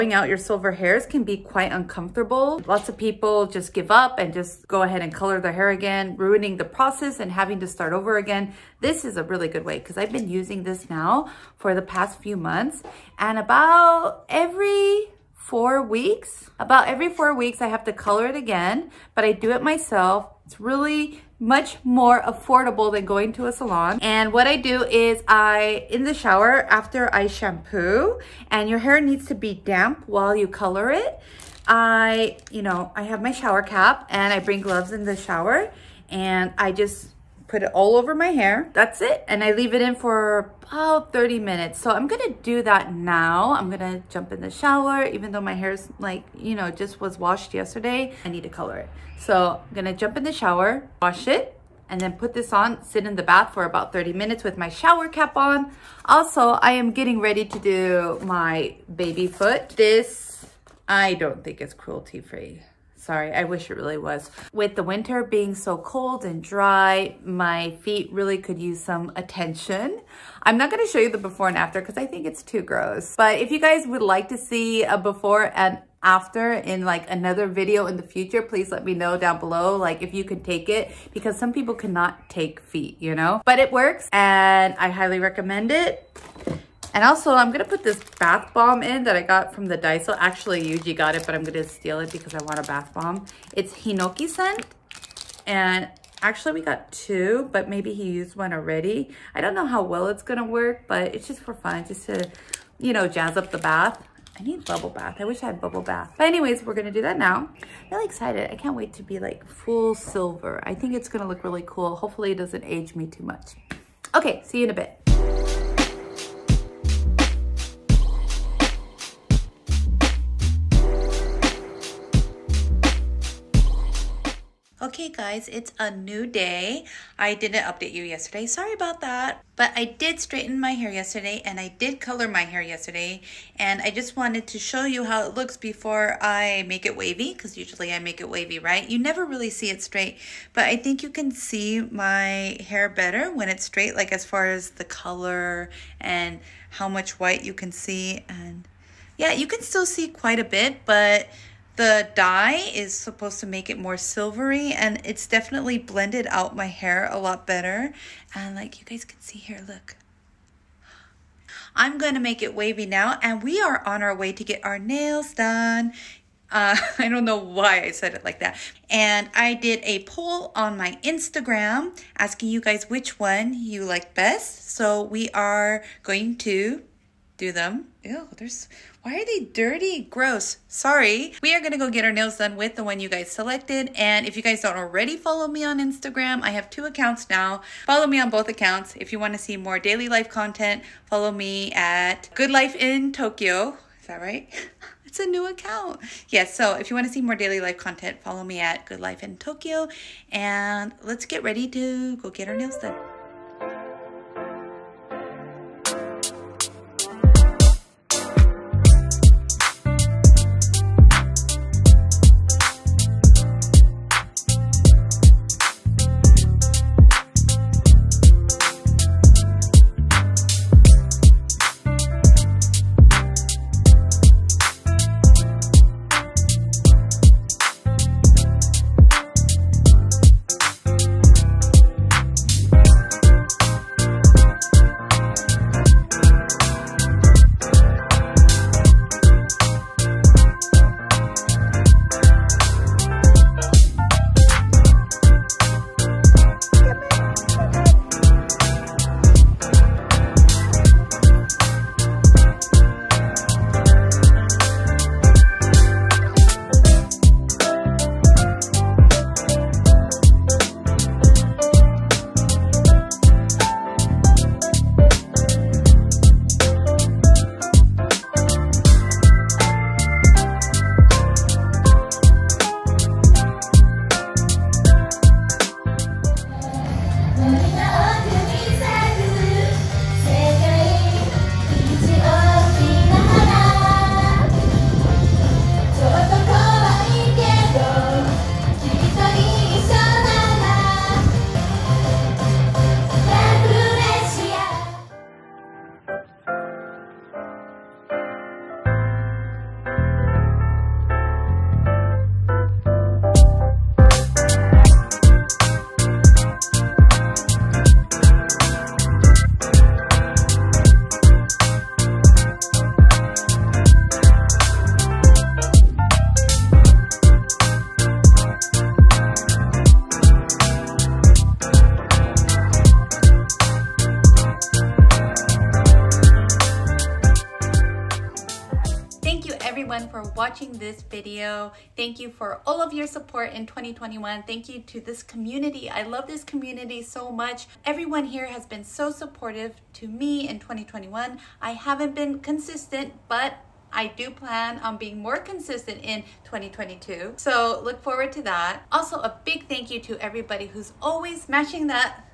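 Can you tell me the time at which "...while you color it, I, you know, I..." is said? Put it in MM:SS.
00:30.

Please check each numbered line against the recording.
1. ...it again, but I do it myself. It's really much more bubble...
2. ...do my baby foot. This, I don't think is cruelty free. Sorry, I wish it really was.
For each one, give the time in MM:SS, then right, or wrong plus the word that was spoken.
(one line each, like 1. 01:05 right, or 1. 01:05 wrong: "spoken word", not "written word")
1. 00:18 wrong: "affordable", not "bubble"
2. 00:57 right.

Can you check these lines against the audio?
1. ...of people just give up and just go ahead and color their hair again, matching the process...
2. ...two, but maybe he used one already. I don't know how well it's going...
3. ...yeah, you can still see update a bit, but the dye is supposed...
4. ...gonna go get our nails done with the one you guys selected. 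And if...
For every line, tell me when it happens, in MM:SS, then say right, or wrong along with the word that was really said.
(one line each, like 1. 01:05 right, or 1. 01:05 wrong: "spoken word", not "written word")
1. 00:02 wrong: "ruining", not "matching"
2. 01:36 right
3. 02:29 wrong: "quite", not "update"
4. 03:01 right.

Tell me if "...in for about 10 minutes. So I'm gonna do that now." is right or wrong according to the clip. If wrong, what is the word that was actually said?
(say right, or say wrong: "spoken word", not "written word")
wrong: "30", not "10".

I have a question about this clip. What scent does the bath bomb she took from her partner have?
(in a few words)
Hinoki.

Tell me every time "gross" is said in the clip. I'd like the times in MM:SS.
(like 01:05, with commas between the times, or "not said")
01:12, 03:00.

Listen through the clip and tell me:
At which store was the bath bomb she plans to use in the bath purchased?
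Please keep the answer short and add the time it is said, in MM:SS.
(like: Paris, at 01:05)
Daiso, at 01:29.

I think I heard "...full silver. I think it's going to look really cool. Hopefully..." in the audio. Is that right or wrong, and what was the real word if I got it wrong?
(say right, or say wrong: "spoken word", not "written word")
right.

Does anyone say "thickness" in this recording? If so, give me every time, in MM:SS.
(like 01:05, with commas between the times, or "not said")
not said.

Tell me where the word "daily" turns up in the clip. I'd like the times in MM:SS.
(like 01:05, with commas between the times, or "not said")
03:09, 03:17.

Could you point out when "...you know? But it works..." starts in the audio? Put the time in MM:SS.
01:22.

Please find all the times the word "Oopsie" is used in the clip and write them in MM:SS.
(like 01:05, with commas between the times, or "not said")
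not said.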